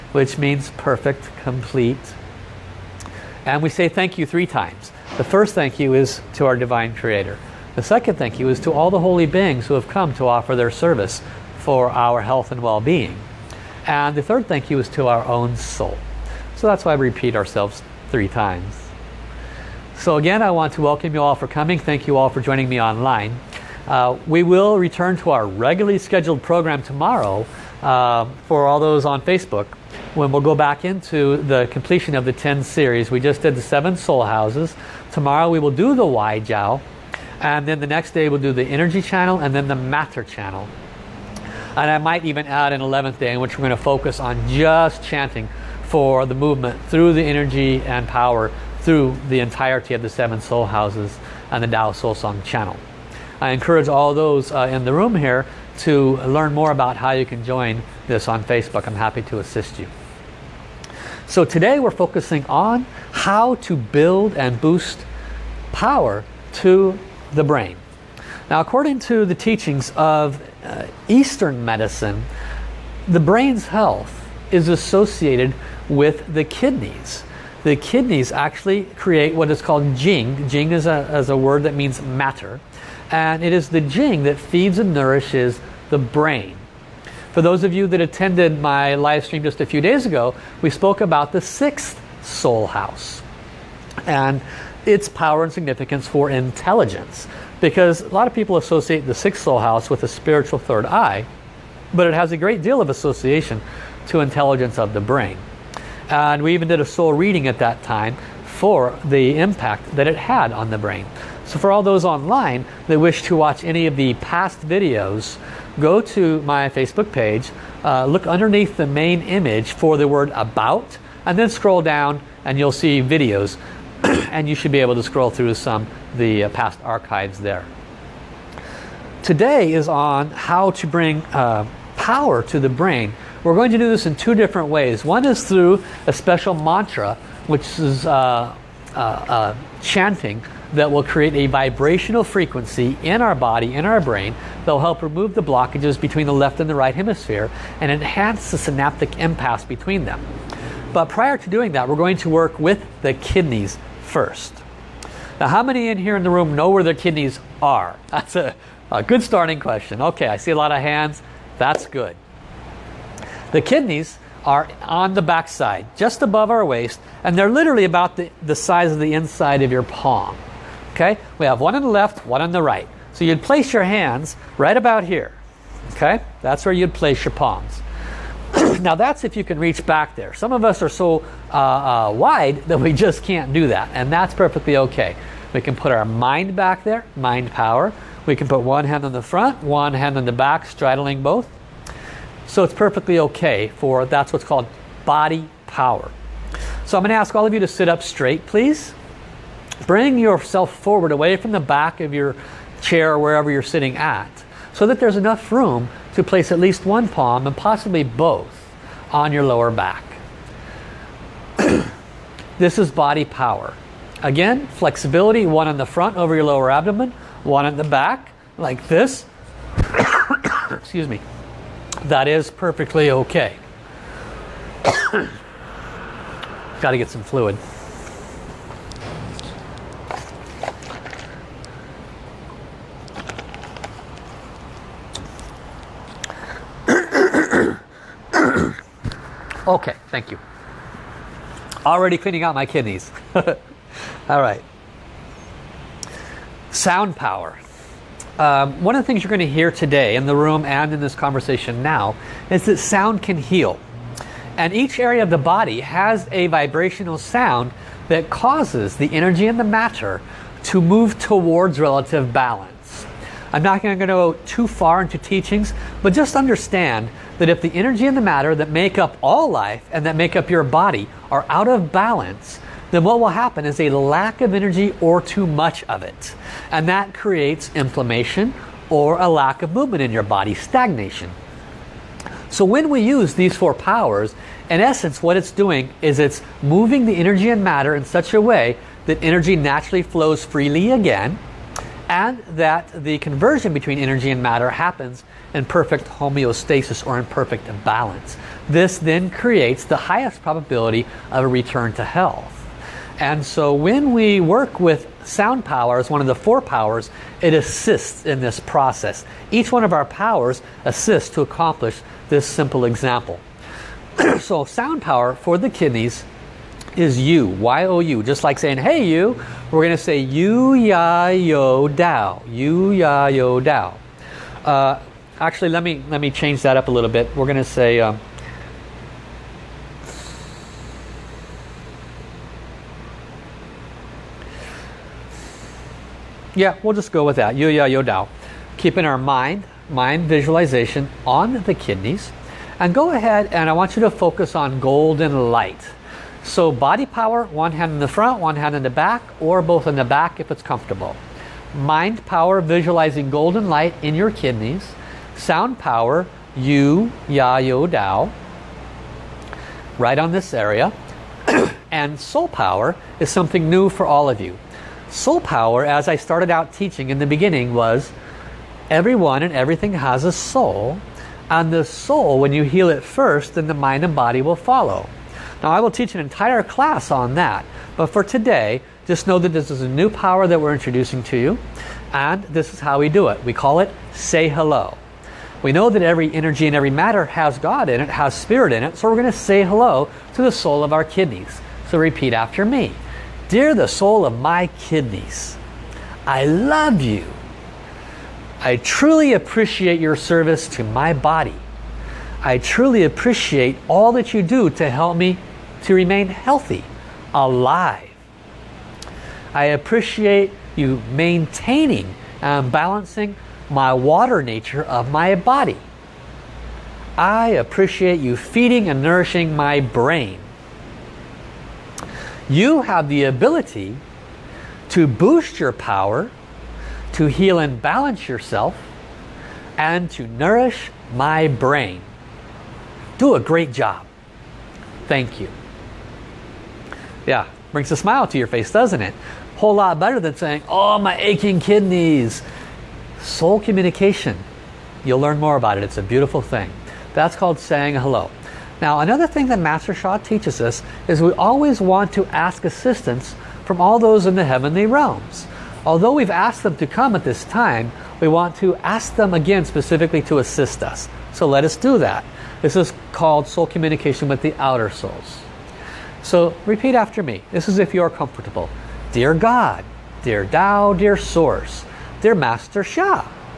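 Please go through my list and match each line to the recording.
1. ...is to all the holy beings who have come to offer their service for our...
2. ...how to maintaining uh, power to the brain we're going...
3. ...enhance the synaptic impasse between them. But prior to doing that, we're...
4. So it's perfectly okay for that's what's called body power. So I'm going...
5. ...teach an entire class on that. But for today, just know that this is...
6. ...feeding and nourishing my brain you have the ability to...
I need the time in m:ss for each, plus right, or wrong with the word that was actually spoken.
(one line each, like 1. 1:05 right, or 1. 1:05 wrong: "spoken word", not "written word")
1. 0:08 right
2. 2:10 wrong: "bring", not "maintaining"
3. 2:27 right
4. 3:12 right
5. 6:15 right
6. 6:58 right.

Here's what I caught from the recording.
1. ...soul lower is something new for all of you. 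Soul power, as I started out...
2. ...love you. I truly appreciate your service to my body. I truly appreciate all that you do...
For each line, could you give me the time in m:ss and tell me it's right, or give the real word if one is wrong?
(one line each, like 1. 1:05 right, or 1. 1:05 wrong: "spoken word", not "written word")
1. 6:02 wrong: "power", not "lower"
2. 6:36 right.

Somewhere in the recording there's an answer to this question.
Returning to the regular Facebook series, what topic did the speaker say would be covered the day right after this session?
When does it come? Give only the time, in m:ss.
0:36.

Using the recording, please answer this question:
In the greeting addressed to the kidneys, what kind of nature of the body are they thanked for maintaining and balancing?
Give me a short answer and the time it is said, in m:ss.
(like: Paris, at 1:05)
water nature, at 6:53.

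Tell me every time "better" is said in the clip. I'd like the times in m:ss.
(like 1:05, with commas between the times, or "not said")
7:19.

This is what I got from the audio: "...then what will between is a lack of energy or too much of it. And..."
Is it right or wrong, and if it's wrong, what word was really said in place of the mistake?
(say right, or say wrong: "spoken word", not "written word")
wrong: "happen", not "between".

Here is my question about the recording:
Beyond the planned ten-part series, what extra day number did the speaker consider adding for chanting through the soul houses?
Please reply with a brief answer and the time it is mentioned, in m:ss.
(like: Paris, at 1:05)
11th, at 0:42.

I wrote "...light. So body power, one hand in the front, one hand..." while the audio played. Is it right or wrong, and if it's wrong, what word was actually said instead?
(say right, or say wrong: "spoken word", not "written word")
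right.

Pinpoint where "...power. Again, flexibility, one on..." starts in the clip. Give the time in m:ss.
3:33.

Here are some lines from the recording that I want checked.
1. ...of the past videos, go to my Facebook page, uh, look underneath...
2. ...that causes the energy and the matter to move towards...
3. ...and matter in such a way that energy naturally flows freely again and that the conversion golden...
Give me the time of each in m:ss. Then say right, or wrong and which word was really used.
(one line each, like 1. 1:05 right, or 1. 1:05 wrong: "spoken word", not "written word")
1. 1:53 right
2. 4:18 right
3. 4:47 wrong: "between", not "golden".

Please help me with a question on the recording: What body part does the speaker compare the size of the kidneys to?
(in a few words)
inside of your palm.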